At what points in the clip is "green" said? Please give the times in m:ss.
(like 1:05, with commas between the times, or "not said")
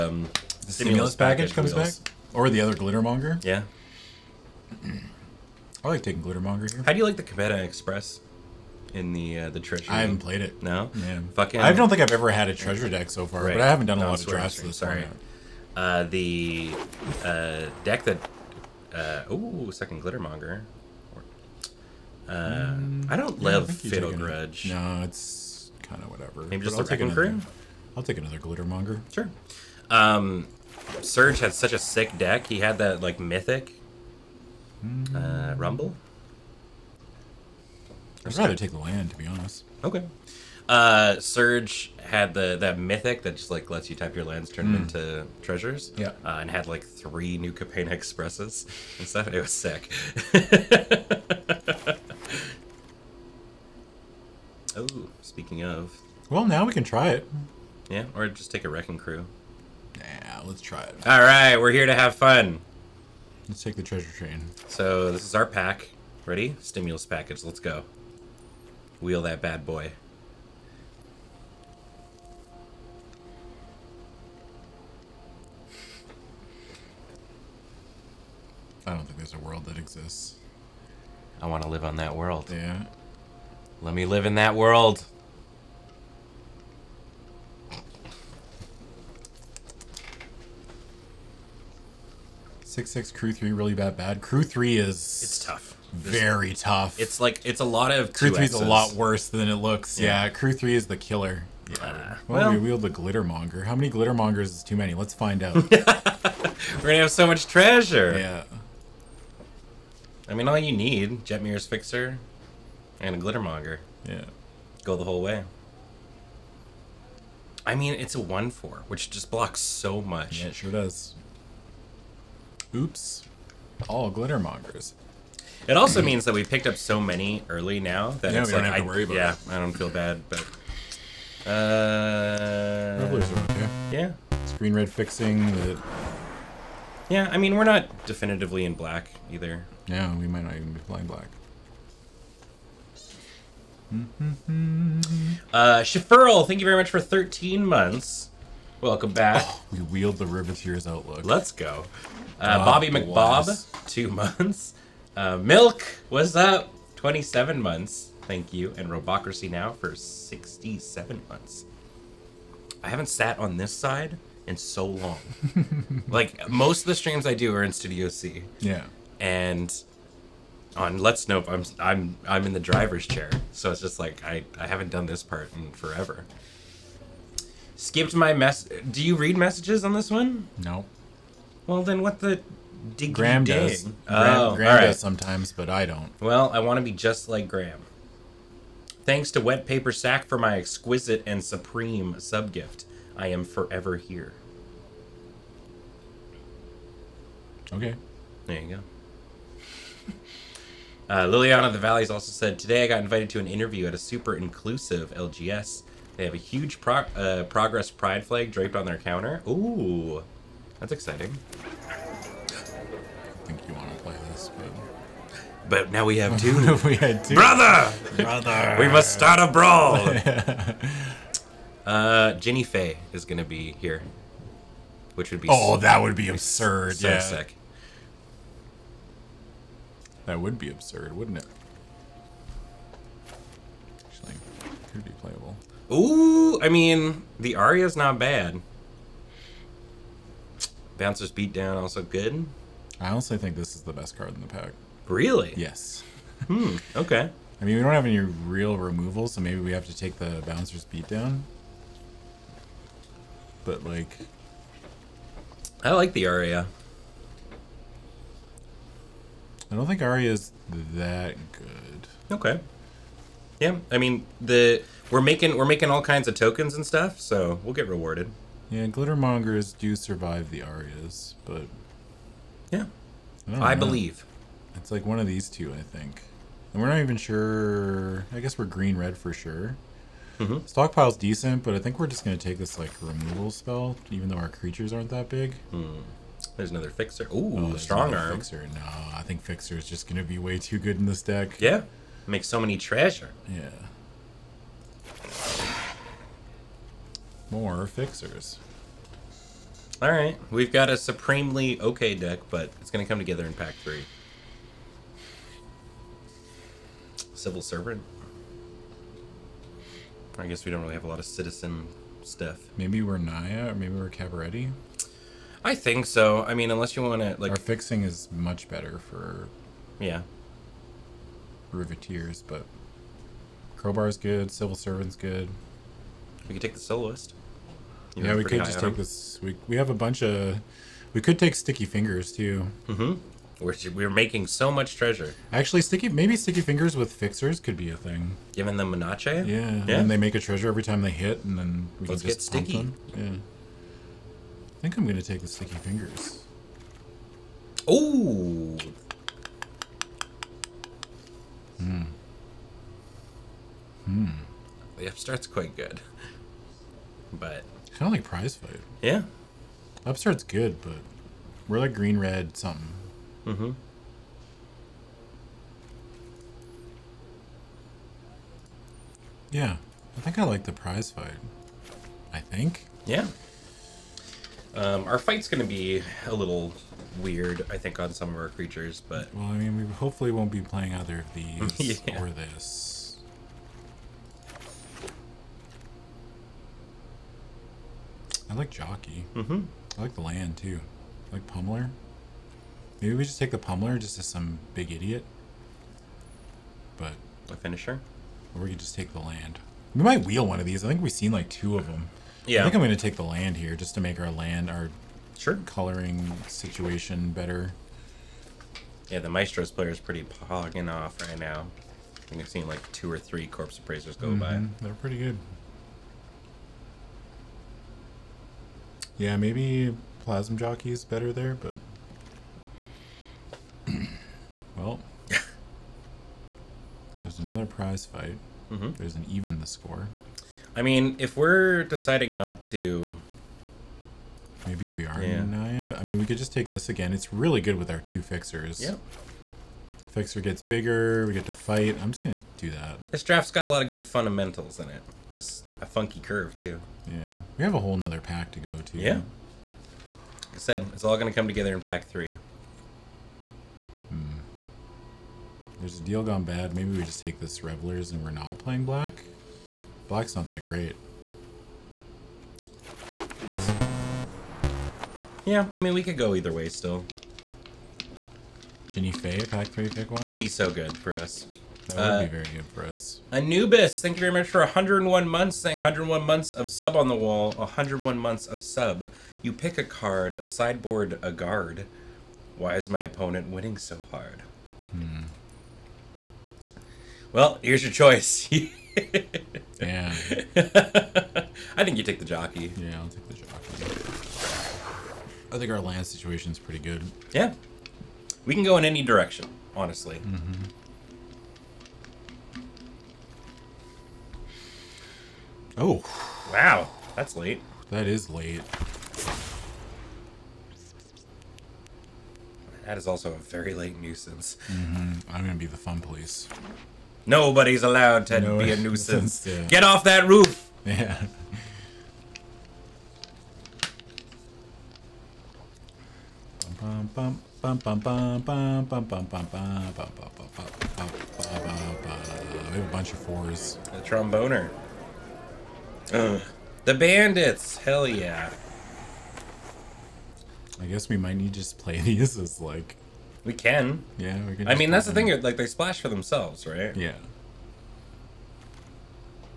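4:38, 6:01.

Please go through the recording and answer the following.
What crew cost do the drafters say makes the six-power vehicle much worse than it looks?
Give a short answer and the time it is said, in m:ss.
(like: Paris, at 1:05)
Crew 3, at 1:40.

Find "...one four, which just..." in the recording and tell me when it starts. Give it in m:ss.
1:58.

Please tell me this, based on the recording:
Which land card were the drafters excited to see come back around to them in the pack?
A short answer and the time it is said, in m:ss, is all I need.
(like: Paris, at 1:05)
Riveteer's Overlook, at 2:30.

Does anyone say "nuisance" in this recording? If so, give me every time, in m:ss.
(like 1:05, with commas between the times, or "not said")
8:33, 8:38.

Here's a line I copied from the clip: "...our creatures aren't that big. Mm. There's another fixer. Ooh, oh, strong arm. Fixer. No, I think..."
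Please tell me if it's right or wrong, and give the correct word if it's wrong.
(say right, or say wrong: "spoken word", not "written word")
right.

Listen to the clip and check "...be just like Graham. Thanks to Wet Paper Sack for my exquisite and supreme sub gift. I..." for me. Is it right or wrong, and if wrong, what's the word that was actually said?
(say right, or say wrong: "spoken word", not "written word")
right.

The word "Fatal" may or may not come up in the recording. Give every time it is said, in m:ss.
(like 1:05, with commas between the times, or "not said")
0:23.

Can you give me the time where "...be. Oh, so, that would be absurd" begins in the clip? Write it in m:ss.
3:45.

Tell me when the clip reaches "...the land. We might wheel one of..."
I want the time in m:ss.
6:39.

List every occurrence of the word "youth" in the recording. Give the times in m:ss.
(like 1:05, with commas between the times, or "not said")
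not said.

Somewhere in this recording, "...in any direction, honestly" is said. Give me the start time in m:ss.
8:18.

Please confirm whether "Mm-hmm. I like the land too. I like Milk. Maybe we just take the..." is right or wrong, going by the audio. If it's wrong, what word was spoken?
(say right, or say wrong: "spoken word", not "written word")
wrong: "Pummeler", not "Milk".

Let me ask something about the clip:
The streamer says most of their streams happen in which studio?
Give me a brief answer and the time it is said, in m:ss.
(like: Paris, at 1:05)
Studio C, at 2:47.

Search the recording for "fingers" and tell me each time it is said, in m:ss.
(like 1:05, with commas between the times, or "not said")
5:31, 5:36, 5:45.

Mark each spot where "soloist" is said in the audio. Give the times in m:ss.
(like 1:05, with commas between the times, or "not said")
5:26.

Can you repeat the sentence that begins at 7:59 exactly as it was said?
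You pick a card, sideboard a guard.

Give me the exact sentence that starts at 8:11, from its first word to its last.
I think you take the jockey.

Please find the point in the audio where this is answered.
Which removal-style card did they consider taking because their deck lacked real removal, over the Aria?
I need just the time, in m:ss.
4:10.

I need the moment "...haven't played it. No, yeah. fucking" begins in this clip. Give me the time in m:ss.
0:09.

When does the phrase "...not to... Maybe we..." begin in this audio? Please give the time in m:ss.
7:12.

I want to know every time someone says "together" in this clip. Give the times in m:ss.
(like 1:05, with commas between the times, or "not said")
5:03, 7:31.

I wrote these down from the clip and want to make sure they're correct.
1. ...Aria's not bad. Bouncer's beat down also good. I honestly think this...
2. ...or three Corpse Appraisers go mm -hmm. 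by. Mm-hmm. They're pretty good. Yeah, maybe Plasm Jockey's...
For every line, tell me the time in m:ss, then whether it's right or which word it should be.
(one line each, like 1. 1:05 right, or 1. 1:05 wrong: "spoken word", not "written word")
1. 3:57 right
2. 6:53 right.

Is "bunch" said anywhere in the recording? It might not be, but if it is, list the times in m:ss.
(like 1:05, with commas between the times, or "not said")
5:29, 8:52.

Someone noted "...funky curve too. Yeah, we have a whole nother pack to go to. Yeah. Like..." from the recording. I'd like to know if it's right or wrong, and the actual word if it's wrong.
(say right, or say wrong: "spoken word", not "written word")
right.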